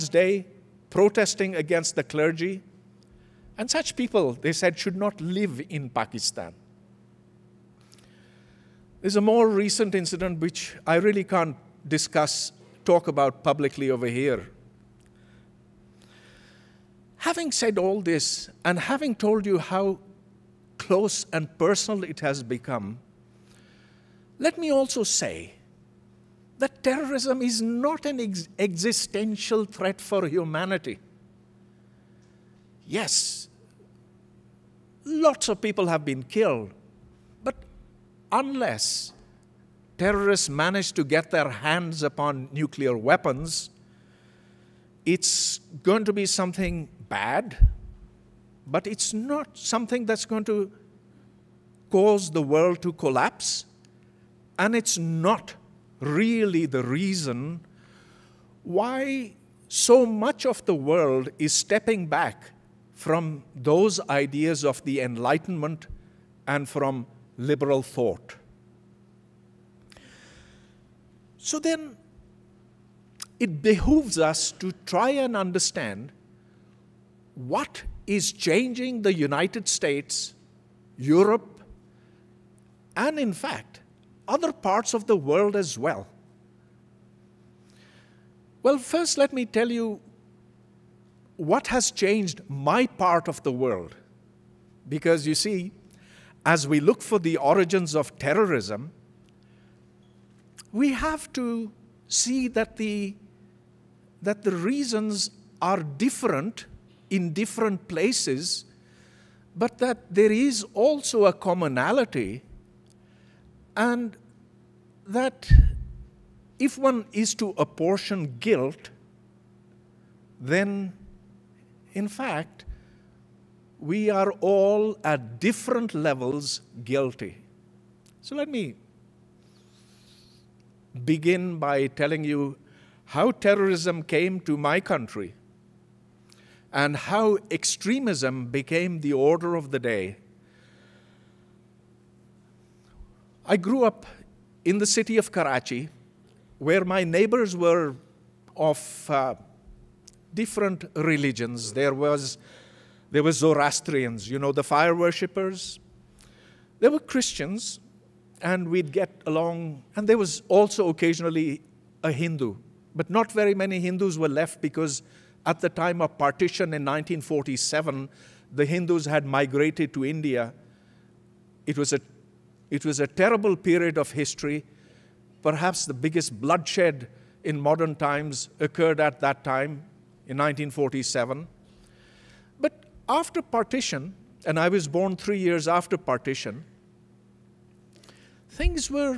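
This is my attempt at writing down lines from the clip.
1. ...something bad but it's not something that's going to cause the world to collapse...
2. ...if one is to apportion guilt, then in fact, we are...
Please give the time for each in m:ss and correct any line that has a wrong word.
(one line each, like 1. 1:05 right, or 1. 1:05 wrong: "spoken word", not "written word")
1. 0:46 right
2. 1:56 right.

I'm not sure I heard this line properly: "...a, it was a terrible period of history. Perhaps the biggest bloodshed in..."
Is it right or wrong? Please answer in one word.
right.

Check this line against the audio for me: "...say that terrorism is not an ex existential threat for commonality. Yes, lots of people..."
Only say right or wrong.
wrong.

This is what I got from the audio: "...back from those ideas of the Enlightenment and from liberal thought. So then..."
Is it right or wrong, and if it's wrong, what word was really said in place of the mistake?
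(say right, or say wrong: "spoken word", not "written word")
right.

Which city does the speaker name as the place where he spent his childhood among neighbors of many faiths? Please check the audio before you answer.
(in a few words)
Karachi.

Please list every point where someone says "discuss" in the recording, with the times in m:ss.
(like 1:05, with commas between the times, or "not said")
0:11.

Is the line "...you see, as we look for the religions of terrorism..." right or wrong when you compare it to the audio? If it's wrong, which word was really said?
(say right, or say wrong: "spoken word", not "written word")
wrong: "origins", not "religions".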